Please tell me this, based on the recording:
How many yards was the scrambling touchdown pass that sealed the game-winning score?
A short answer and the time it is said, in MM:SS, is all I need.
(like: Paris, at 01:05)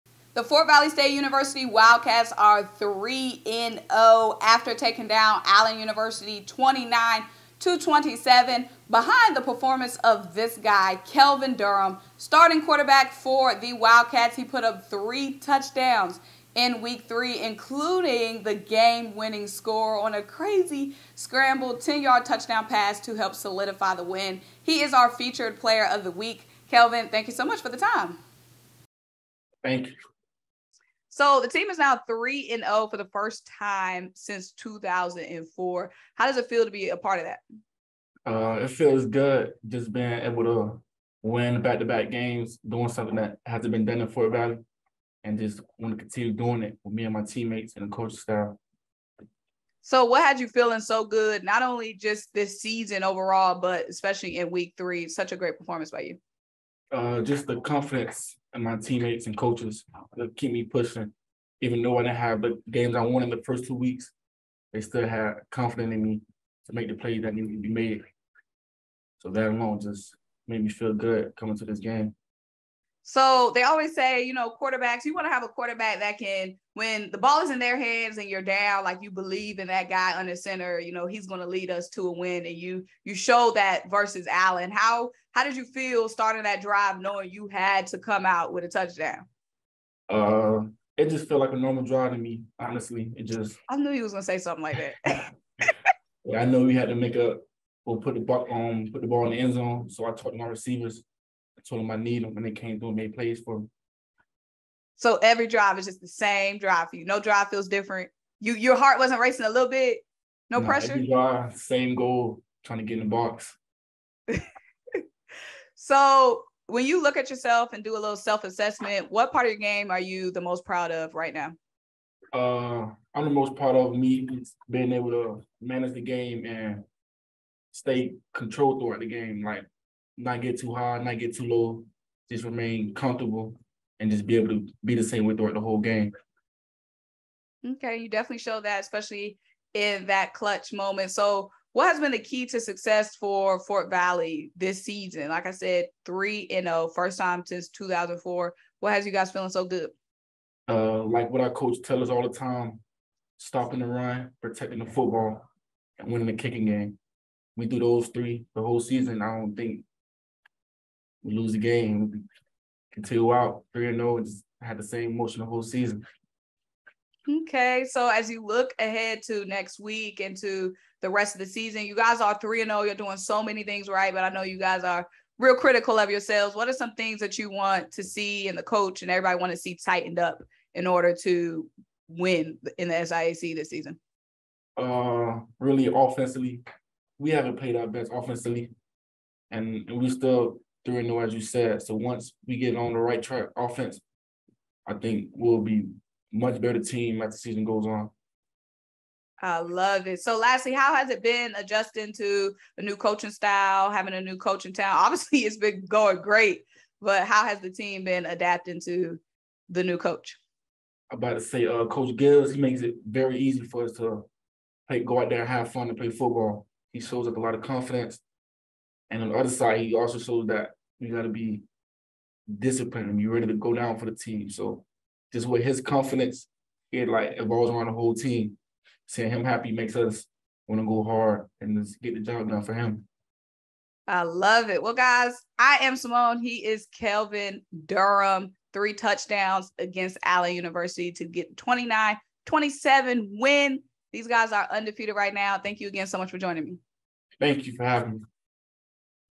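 10, at 00:21.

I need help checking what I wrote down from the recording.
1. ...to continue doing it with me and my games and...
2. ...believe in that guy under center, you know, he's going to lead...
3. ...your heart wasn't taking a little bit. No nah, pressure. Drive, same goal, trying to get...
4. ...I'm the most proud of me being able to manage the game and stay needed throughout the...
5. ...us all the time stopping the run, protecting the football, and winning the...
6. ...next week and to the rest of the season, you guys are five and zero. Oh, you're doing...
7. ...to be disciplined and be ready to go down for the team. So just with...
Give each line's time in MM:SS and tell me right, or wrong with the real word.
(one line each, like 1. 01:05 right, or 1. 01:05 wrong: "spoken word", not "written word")
1. 00:45 wrong: "teammates", not "games"
2. 01:19 right
3. 01:48 wrong: "racing", not "taking"
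4. 02:03 wrong: "controlled", not "needed"
5. 02:32 right
6. 02:49 wrong: "three", not "five"
7. 03:41 right.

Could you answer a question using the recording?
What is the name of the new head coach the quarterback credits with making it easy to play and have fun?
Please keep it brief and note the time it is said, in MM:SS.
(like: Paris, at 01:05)
Coach Gibbs, at 03:31.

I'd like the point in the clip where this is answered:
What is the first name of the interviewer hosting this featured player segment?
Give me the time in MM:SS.
03:55.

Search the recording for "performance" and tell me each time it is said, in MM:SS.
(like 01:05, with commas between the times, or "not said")
00:09, 00:55.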